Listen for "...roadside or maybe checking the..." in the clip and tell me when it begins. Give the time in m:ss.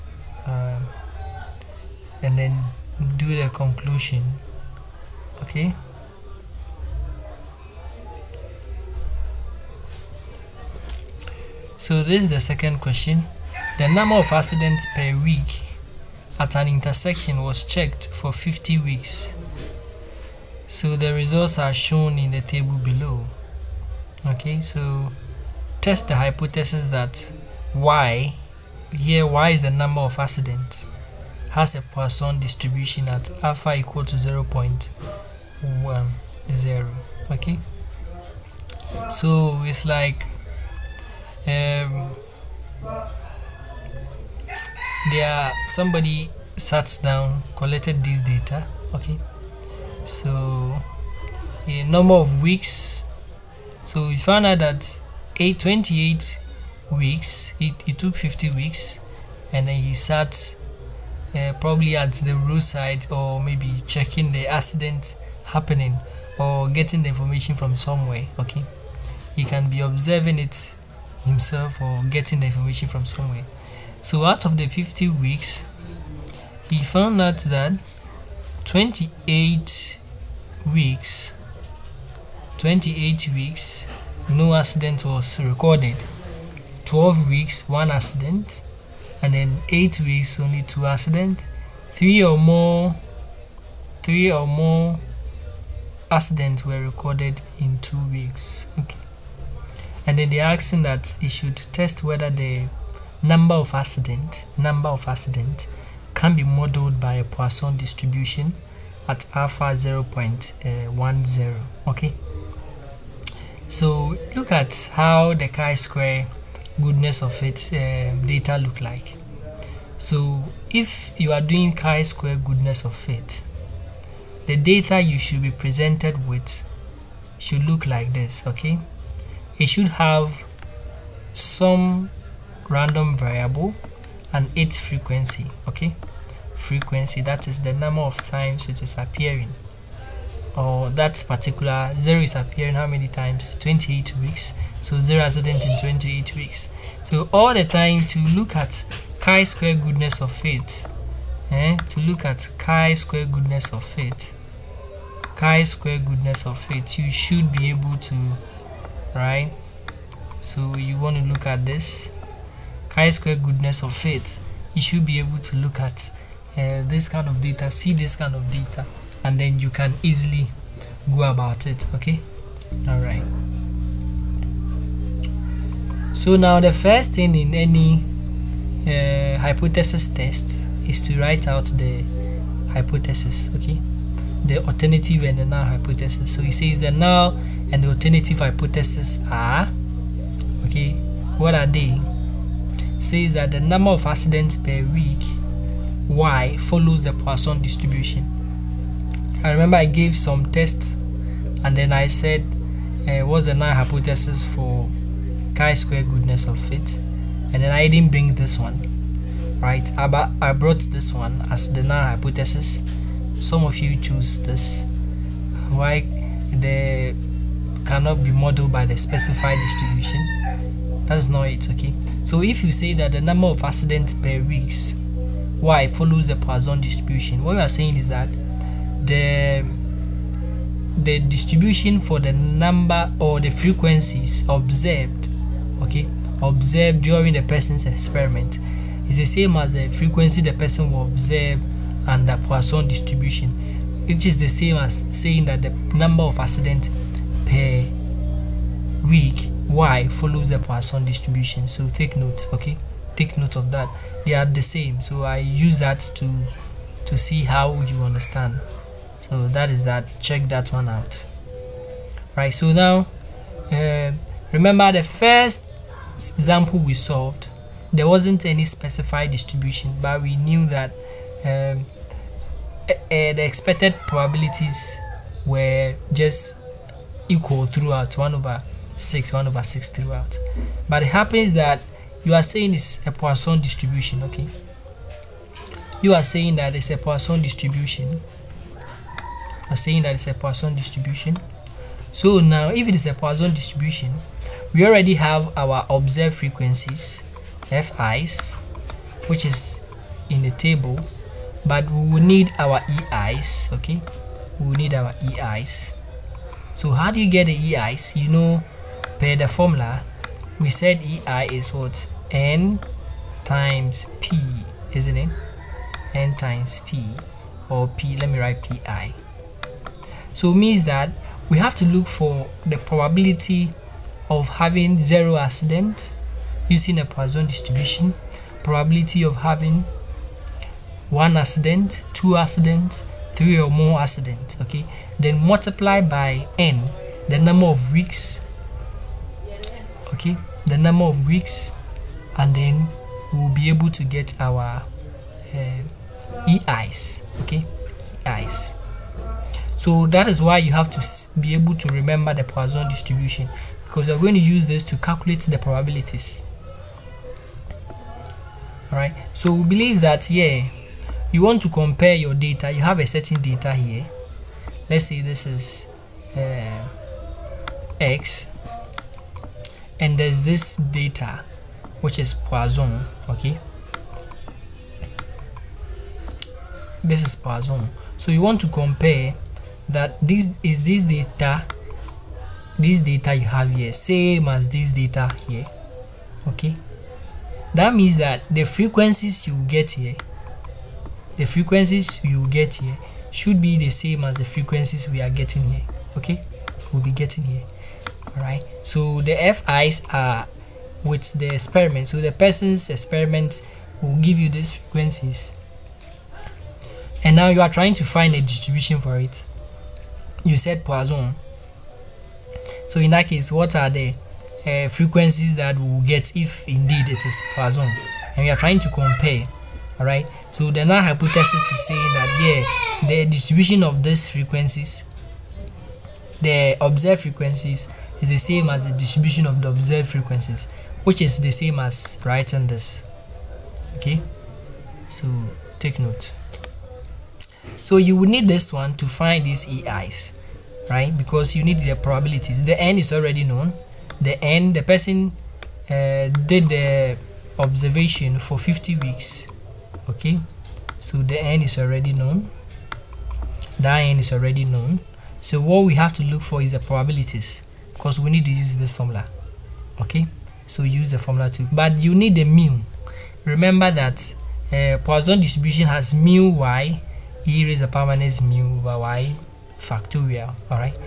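1:02.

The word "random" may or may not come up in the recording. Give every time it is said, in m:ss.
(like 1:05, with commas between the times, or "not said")
2:12.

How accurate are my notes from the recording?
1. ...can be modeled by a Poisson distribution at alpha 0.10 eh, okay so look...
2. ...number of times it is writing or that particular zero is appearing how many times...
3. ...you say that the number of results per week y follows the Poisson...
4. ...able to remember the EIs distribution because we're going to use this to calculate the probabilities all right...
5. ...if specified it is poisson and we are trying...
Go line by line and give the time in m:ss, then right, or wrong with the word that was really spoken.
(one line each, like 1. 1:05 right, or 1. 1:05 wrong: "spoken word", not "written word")
1. 1:46 right
2. 2:17 wrong: "appearing", not "writing"
3. 3:42 wrong: "accidents", not "results"
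4. 5:51 wrong: "Poisson", not "EIs"
5. 6:56 wrong: "indeed", not "specified".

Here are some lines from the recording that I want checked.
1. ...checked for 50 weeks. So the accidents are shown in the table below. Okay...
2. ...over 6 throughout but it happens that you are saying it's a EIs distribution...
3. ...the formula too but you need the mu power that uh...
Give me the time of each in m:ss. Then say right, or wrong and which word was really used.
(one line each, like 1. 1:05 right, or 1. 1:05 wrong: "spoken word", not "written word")
1. 0:17 wrong: "results", not "accidents"
2. 4:39 wrong: "Poisson", not "EIs"
3. 7:41 wrong: "remember", not "power".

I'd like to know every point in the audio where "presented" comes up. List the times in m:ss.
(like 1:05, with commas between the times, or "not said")
2:05.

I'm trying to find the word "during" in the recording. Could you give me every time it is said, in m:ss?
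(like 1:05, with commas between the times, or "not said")
3:57.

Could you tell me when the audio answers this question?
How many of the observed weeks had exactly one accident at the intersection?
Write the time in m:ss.
1:26.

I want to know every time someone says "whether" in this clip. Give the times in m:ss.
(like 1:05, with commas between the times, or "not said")
1:42.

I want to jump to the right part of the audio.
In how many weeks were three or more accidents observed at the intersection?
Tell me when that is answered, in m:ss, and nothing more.
1:36.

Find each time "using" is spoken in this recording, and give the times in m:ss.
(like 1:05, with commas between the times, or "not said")
5:26.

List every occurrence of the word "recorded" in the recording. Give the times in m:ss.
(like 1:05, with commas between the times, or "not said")
1:25, 1:36.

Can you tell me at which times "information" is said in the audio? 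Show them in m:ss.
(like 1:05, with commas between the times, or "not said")
1:07, 1:12.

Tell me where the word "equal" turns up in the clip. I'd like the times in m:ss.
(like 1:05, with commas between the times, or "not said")
0:33, 4:37.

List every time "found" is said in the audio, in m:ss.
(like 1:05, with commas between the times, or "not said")
0:54, 1:16.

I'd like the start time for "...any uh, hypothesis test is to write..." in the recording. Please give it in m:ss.
2:57.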